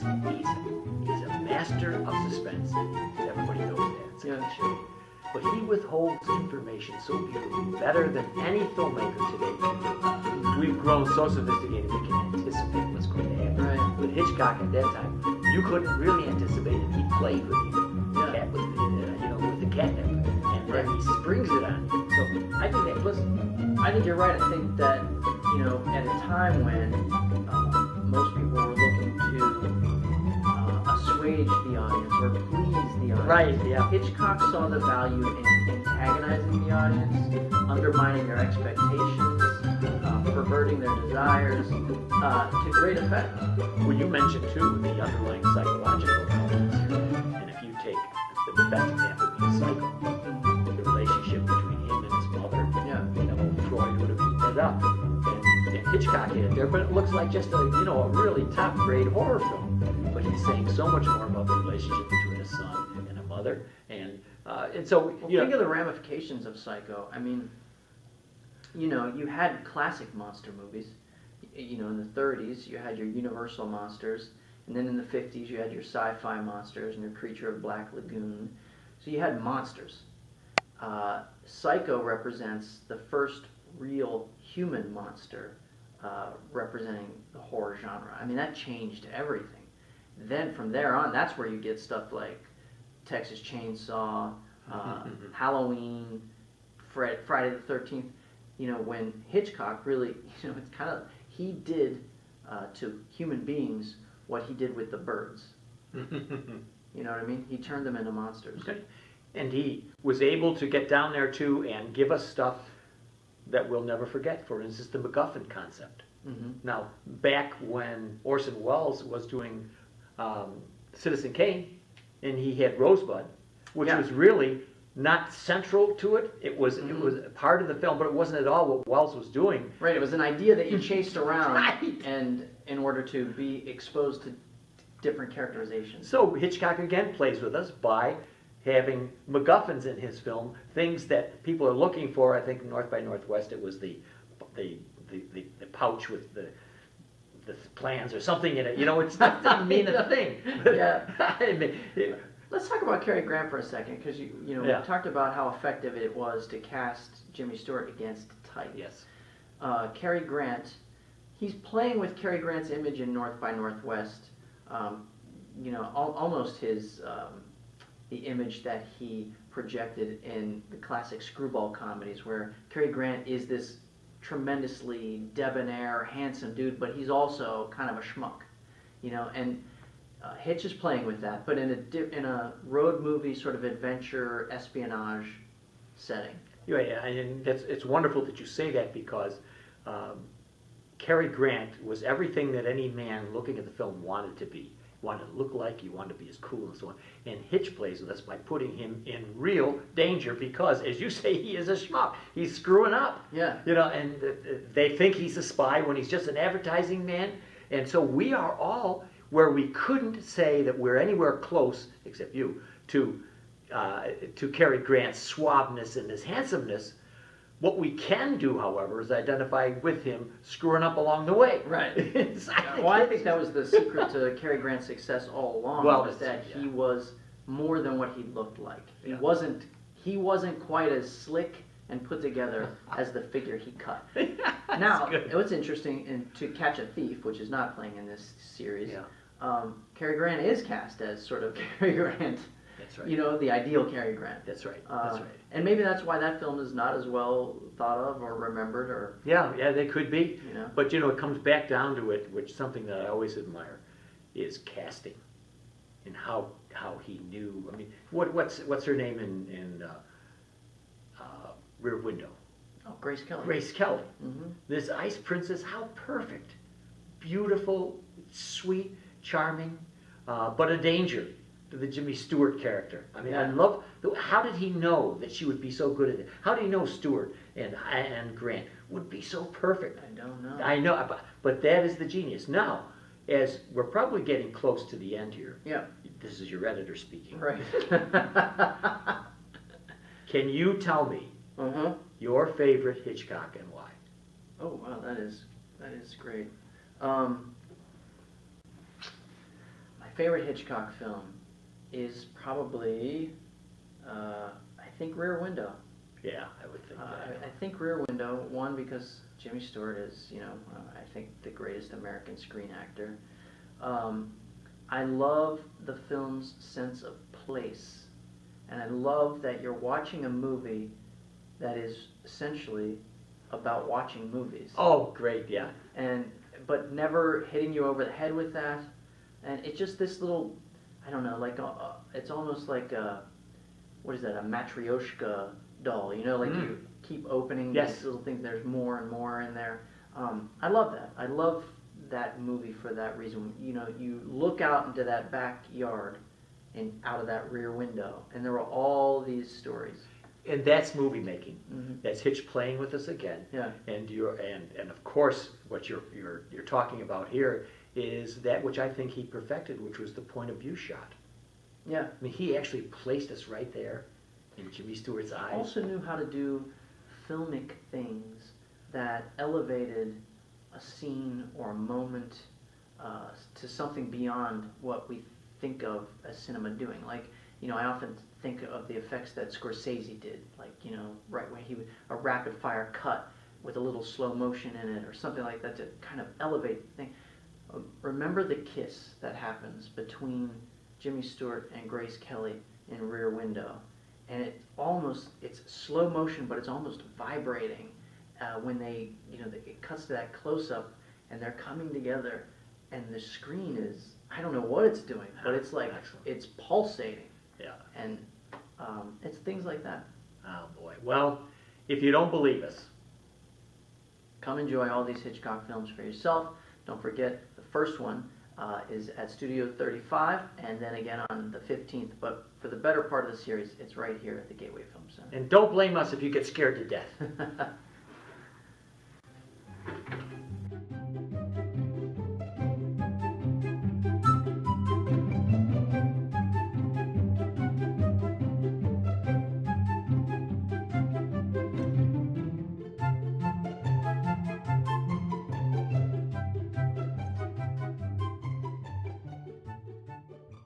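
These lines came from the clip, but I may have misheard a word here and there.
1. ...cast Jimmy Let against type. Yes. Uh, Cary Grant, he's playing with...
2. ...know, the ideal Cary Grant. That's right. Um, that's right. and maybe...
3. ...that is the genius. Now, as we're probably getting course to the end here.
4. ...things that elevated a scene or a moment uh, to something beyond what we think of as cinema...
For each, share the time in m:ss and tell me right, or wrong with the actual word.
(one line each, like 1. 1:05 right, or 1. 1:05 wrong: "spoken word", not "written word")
1. 2:36 wrong: "Stewart", not "Let"
2. 4:03 right
3. 4:41 wrong: "close", not "course"
4. 6:07 right.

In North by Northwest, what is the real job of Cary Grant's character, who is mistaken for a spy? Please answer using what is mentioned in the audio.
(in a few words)
advertising man.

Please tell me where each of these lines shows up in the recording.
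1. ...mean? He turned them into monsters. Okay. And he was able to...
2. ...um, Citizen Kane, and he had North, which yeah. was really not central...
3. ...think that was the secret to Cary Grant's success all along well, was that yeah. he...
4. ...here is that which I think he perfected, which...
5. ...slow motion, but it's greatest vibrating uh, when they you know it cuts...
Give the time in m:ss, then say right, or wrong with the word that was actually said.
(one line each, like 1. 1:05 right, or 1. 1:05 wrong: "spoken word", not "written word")
1. 1:47 right
2. 2:00 wrong: "Rosebud", not "North"
3. 3:43 right
4. 5:57 right
5. 6:35 wrong: "almost", not "greatest".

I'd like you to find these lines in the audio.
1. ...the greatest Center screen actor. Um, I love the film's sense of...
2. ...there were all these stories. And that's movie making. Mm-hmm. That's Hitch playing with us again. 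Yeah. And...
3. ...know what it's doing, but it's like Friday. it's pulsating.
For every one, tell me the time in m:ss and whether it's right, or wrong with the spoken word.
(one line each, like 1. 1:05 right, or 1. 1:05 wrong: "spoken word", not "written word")
1. 5:11 wrong: "American", not "Center"
2. 5:48 right
3. 6:44 wrong: "Excellent", not "Friday".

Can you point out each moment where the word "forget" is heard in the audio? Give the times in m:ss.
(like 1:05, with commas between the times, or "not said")
1:54, 6:57.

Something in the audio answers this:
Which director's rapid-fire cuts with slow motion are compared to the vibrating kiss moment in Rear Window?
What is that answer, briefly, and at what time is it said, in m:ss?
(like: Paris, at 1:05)
Scorsese, at 6:19.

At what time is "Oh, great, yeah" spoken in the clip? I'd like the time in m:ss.
5:24.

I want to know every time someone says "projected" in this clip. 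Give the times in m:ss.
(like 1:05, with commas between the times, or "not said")
2:49.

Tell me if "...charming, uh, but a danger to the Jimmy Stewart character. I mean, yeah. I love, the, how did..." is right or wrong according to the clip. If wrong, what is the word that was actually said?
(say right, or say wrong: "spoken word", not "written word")
right.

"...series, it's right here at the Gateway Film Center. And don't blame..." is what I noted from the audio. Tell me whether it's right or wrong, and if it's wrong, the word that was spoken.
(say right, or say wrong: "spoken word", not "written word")
right.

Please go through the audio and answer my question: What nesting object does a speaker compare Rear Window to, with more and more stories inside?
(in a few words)
matryoshka doll.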